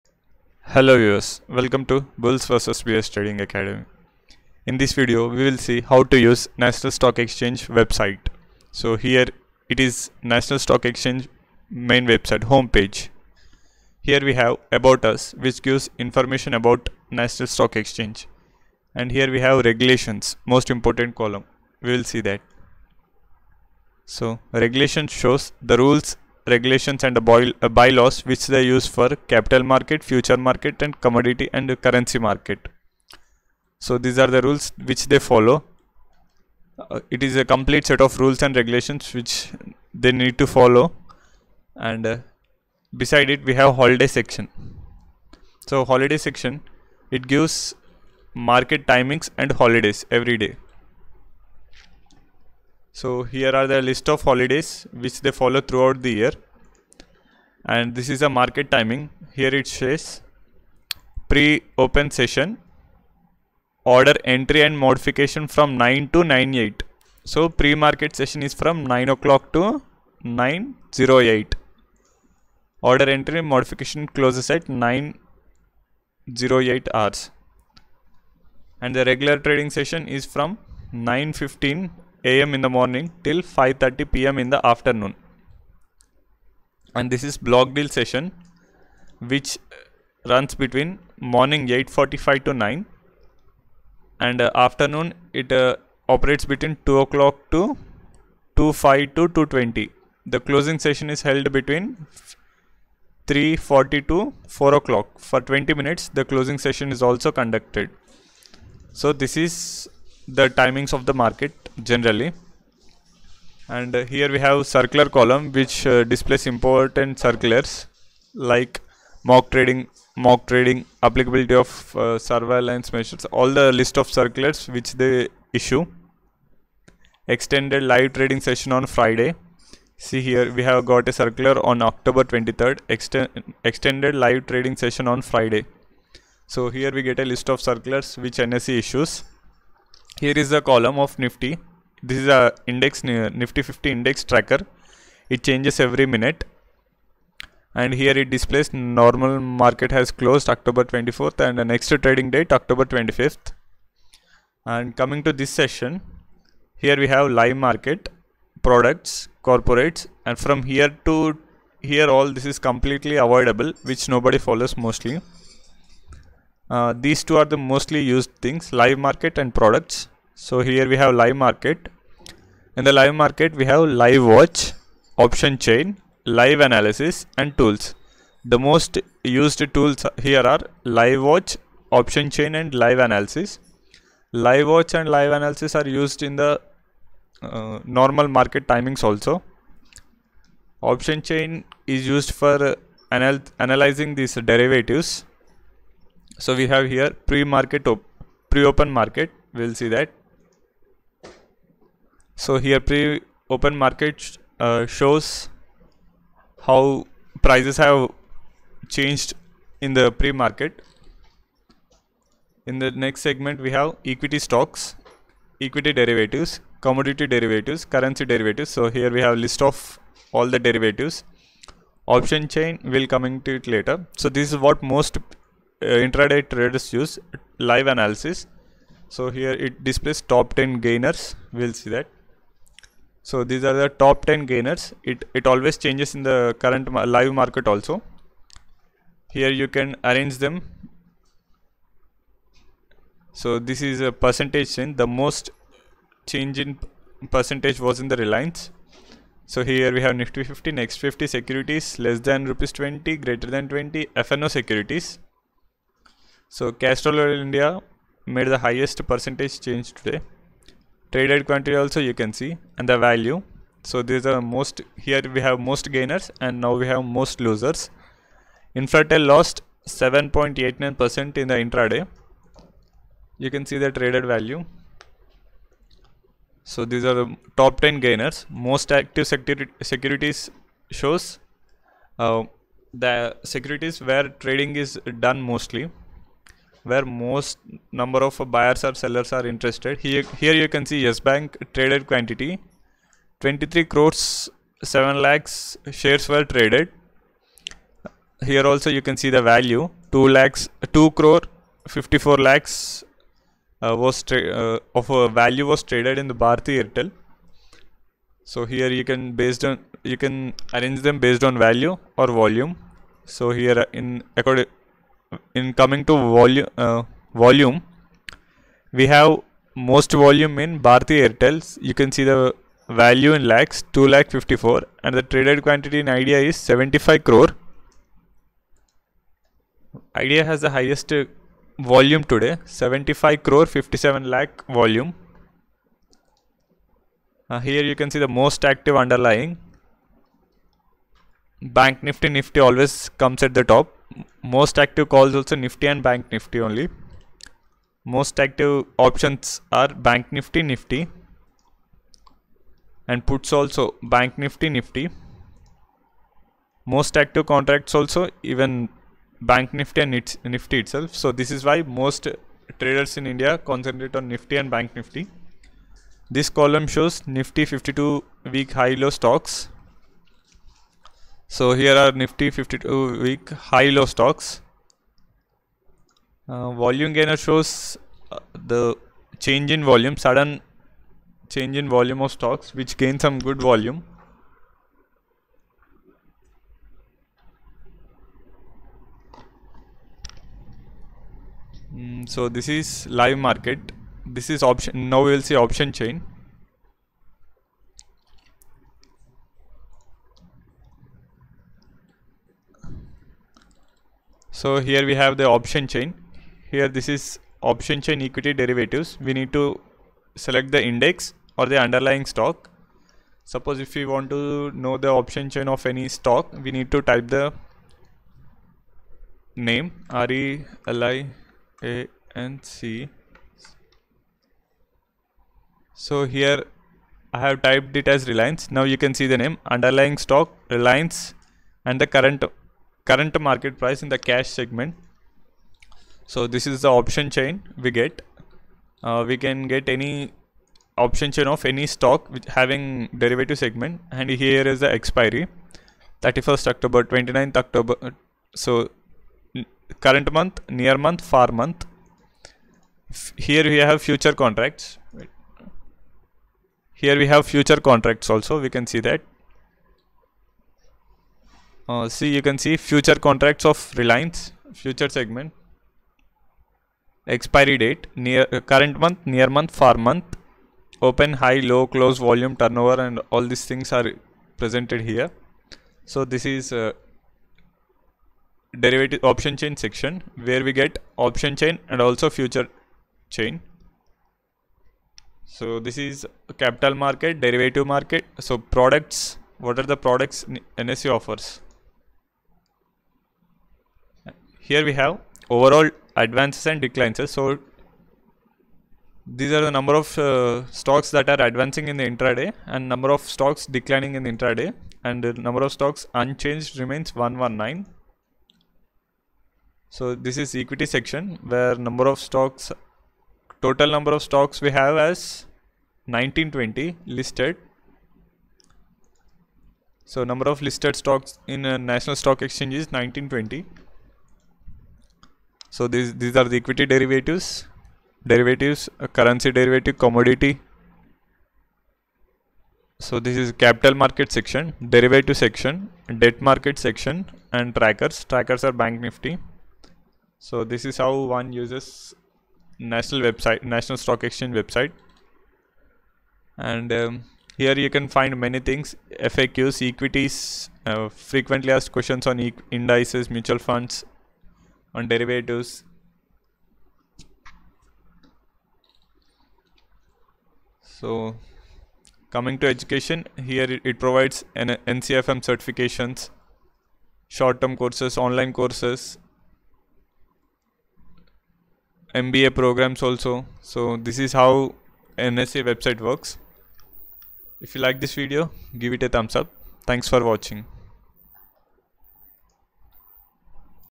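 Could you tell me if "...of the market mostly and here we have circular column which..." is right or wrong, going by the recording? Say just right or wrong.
wrong.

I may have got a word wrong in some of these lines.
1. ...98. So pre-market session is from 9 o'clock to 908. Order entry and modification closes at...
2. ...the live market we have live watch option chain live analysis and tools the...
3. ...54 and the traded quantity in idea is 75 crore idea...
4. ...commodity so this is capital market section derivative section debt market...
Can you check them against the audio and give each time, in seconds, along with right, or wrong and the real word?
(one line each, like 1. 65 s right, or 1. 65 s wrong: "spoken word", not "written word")
1. 66 s right
2. 172 s right
3. 324 s right
4. 529 s right.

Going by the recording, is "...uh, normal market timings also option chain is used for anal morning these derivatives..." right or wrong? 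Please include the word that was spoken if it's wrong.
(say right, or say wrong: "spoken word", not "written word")
wrong: "analyzing", not "morning".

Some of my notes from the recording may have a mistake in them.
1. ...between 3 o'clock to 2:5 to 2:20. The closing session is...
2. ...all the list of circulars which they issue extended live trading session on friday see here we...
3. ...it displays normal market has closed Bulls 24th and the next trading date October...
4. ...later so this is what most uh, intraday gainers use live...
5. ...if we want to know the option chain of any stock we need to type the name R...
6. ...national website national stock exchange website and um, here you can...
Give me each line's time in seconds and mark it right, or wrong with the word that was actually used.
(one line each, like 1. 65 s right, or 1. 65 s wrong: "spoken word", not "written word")
1. 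96 s wrong: "2", not "3"
2. 123 s right
3. 148 s wrong: "October", not "Bulls"
4. 223 s wrong: "traders", not "gainers"
5. 413 s right
6. 542 s right.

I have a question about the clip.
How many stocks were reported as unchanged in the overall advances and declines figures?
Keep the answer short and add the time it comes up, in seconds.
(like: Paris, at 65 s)
119, at 507 s.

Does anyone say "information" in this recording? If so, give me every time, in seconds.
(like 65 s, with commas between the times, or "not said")
15 s.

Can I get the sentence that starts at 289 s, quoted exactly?
Here, here you can see Yes Bank traded quantity, 23 crores, 7 lakhs shares were traded.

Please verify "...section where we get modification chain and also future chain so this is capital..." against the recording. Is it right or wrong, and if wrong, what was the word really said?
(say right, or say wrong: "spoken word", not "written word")
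wrong: "option", not "modification".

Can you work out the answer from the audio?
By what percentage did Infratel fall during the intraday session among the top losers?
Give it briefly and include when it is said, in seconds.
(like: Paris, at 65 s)
7.89 percent, at 269 s.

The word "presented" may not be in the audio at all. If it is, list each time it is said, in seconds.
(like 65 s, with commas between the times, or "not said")
474 s.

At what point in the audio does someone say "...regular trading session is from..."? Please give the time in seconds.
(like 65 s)
79 s.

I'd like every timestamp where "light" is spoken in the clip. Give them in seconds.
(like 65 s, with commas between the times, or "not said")
not said.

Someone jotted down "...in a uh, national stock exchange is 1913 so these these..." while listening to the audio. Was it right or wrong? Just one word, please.
wrong.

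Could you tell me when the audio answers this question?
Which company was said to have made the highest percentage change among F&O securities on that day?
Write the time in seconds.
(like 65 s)
256 s.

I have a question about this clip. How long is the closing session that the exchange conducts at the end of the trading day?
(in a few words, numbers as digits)
20 minutes.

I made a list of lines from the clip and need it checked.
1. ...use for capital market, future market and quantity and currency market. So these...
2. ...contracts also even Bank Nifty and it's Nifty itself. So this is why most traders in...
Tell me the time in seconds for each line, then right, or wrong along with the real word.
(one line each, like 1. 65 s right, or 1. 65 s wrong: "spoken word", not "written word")
1. 28 s wrong: "commodity", not "quantity"
2. 357 s right.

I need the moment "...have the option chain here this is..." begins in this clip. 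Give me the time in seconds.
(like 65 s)
405 s.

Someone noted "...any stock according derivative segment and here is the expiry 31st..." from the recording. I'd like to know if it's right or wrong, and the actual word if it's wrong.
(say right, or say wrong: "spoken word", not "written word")
wrong: "having", not "according".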